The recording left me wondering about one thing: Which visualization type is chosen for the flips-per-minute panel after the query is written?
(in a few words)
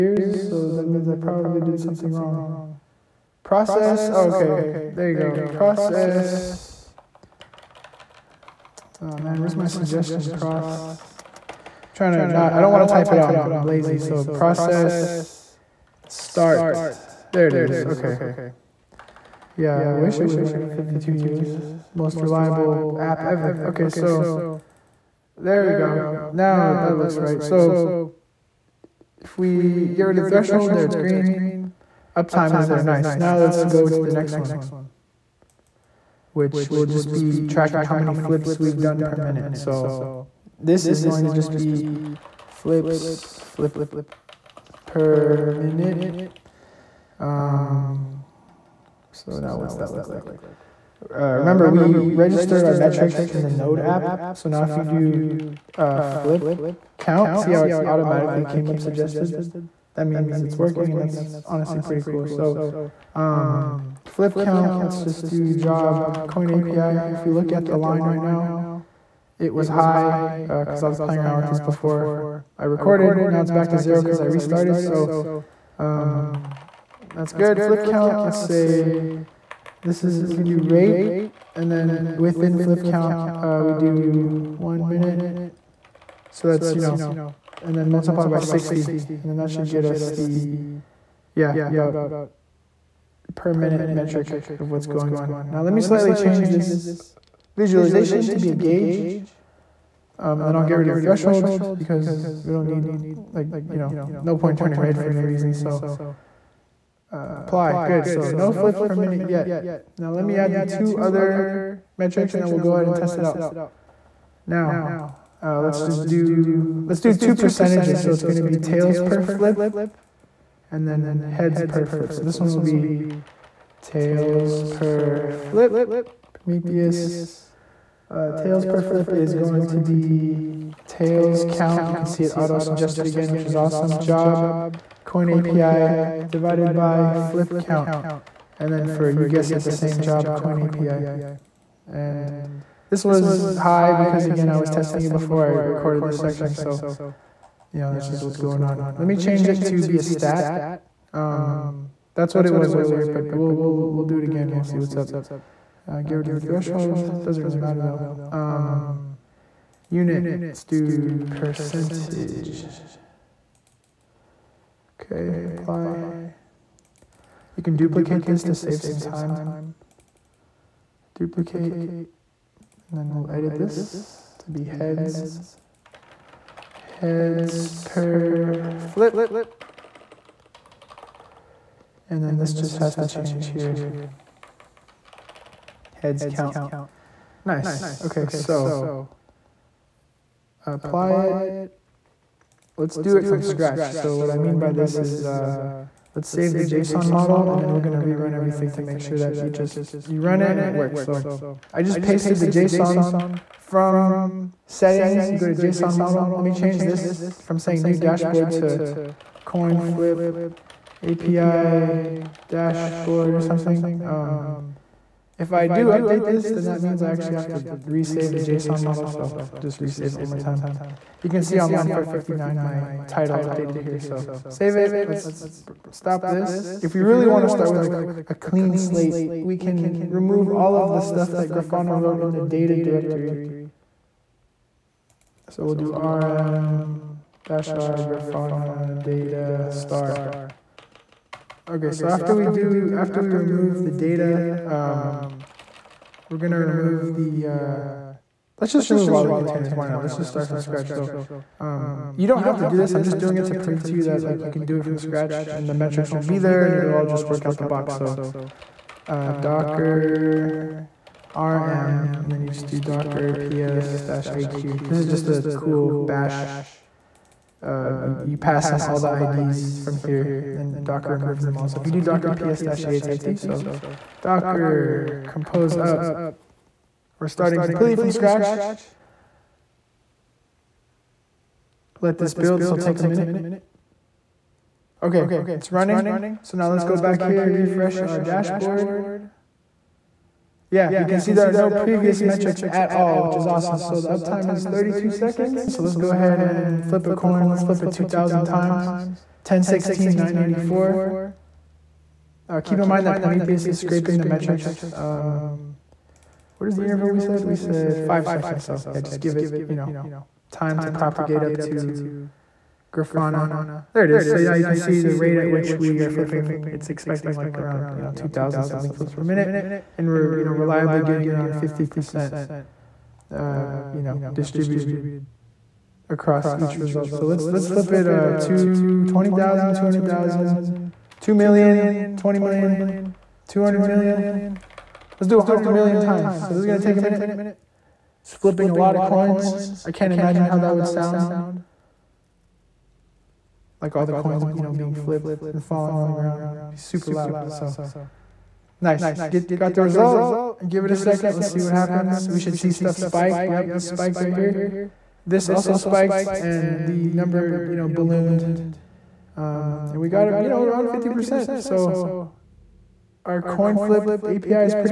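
gauge.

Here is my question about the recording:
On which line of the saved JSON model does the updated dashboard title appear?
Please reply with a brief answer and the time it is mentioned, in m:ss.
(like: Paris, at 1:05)
459, at 3:41.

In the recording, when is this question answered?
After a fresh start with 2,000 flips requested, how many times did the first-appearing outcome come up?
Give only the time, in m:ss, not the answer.
4:59.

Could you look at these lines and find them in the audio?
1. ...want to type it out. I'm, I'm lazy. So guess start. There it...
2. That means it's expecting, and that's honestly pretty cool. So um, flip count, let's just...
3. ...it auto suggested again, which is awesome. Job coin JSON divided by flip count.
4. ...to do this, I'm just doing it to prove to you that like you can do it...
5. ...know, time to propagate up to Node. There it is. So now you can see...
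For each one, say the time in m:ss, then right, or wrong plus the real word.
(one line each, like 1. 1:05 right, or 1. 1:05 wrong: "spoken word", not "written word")
1. 0:12 wrong: "process", not "guess"
2. 0:59 wrong: "working", not "expecting"
3. 2:12 wrong: "API", not "JSON"
4. 4:12 right
5. 5:09 wrong: "Grafana", not "Node".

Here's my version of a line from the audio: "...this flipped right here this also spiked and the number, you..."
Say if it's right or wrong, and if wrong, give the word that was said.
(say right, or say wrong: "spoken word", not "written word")
wrong: "spiked", not "flipped".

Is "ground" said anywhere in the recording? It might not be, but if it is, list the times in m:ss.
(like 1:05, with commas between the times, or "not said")
5:46.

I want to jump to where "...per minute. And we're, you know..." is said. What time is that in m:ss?
5:19.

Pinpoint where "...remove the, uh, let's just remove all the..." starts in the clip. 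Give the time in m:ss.
4:06.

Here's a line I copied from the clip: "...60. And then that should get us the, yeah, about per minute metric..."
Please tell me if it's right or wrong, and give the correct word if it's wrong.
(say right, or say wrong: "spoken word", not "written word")
right.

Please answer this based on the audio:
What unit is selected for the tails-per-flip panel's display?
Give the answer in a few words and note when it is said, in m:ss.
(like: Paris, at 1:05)
percentage, at 2:41.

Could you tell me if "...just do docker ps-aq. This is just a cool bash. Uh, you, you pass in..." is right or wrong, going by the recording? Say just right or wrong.
right.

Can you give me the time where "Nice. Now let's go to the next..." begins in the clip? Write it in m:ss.
0:32.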